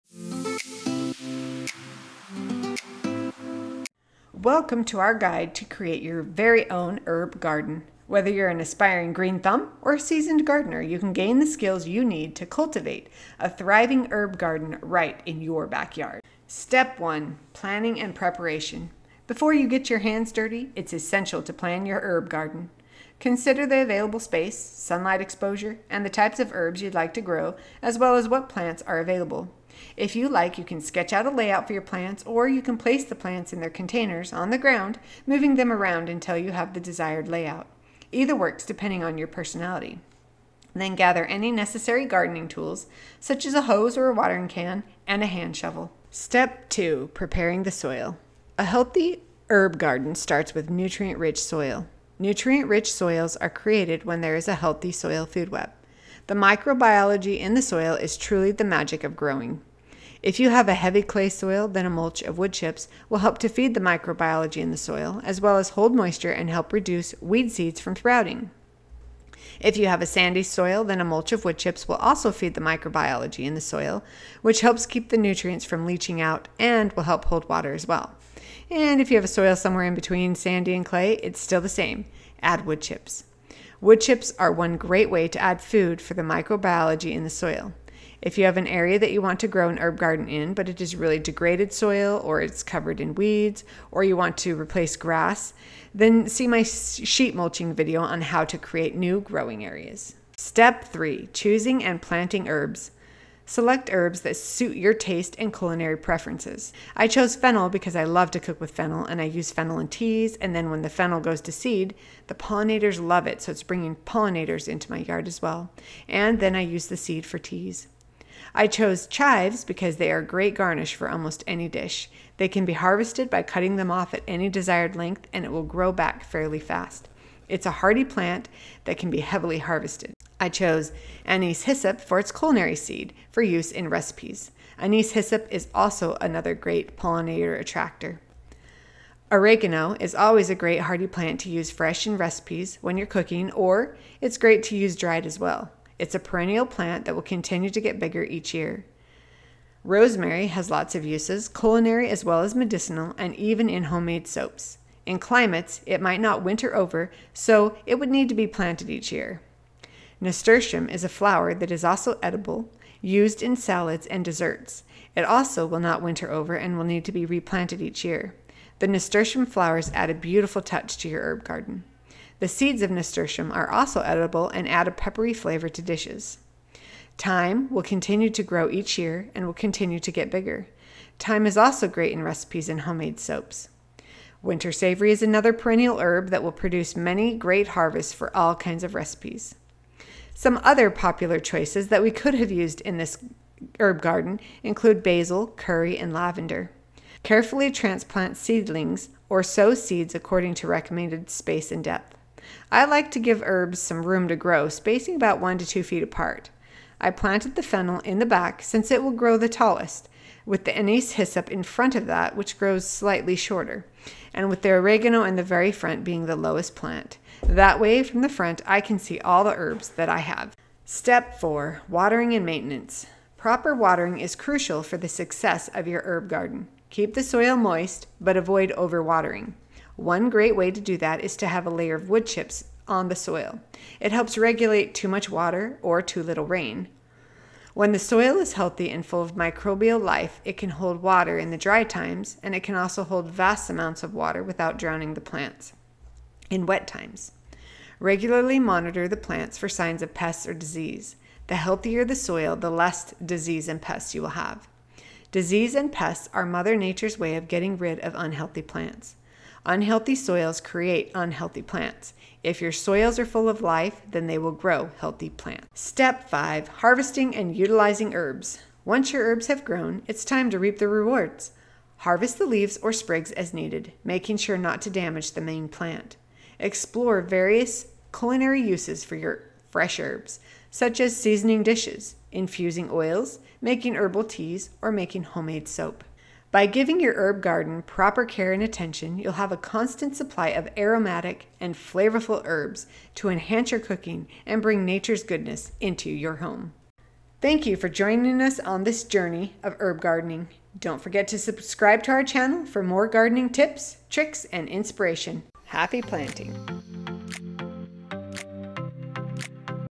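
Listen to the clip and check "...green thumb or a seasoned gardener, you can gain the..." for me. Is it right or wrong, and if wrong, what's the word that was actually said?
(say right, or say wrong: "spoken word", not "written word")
right.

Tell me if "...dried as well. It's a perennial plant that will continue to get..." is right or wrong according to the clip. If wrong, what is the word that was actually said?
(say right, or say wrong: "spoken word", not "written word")
right.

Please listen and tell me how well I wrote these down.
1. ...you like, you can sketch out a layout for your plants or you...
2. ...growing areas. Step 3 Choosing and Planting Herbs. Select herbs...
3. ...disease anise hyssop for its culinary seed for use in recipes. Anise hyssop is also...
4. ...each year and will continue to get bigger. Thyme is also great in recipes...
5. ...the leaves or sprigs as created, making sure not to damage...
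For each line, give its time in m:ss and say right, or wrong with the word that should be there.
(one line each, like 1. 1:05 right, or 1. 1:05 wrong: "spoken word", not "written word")
1. 0:30 right
2. 1:39 right
3. 2:10 wrong: "chose", not "disease"
4. 2:58 right
5. 4:32 wrong: "needed", not "created".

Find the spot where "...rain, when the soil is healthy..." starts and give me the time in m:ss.
3:56.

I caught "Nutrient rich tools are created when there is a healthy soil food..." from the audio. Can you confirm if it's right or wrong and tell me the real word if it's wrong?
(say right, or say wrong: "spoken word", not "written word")
wrong: "soils", not "tools".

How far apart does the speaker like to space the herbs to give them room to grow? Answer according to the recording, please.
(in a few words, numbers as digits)
1 to 2 feet.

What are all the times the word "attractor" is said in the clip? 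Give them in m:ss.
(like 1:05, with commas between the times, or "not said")
2:17.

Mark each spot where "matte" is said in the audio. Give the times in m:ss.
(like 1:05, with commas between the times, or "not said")
not said.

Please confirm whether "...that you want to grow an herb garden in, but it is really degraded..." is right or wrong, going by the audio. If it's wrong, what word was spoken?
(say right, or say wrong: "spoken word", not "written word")
right.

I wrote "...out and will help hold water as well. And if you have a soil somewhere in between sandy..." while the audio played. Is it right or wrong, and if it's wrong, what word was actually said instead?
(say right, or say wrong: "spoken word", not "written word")
right.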